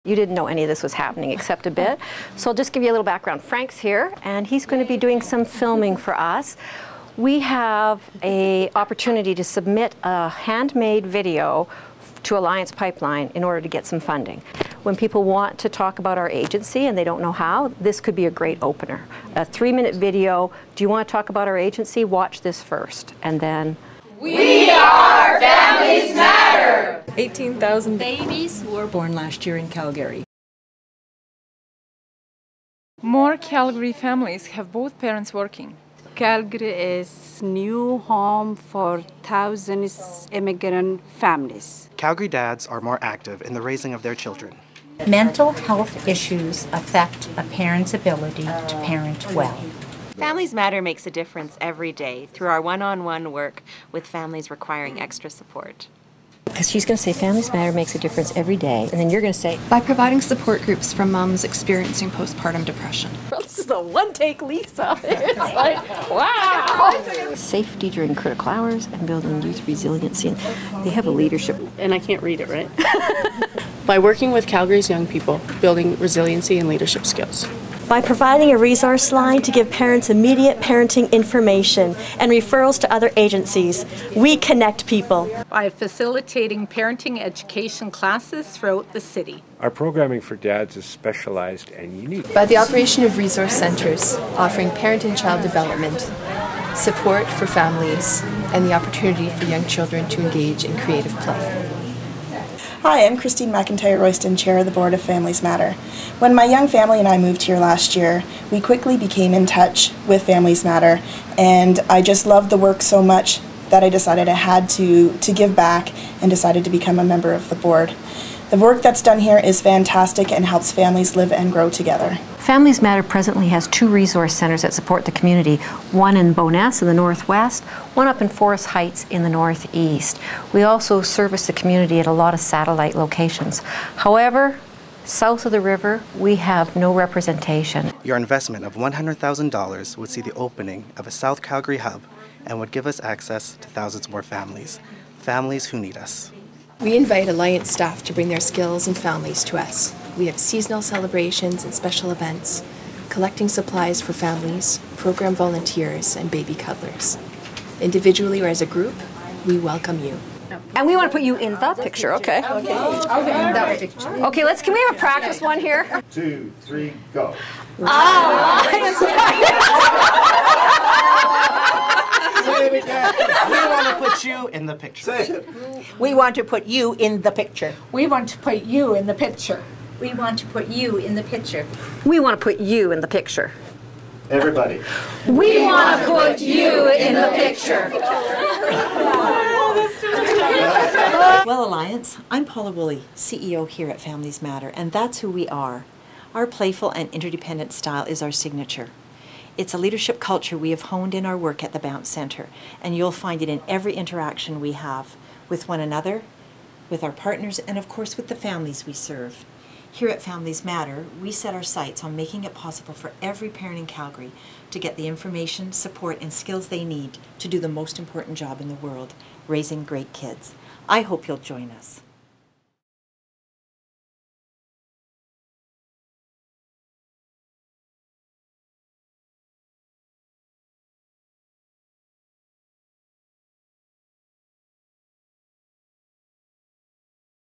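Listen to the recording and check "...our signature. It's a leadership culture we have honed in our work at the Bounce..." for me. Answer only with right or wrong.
right.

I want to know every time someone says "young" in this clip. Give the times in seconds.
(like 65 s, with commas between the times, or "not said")
74 s, 99 s, 106 s.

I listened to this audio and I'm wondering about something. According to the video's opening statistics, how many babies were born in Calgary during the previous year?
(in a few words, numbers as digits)
18,000.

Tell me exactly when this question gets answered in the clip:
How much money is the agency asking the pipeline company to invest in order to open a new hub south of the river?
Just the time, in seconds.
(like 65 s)
138 s.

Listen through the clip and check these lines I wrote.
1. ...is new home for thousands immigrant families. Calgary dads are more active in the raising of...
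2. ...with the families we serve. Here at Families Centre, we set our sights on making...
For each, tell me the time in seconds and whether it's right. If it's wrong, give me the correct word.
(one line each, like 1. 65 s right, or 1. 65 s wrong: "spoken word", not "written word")
1. 37 s right
2. 208 s wrong: "Matter", not "Centre".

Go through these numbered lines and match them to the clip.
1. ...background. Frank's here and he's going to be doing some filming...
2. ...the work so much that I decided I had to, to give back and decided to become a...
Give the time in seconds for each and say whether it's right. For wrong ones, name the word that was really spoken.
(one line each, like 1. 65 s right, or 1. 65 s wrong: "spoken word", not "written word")
1. 3 s right
2. 112 s right.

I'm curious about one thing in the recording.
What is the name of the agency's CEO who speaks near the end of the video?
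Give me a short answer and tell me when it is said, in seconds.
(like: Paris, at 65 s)
Paula Woolley, at 192 s.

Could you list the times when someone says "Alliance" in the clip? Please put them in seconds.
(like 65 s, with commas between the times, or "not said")
12 s, 147 s, 191 s.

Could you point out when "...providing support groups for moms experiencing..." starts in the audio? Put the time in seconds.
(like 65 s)
59 s.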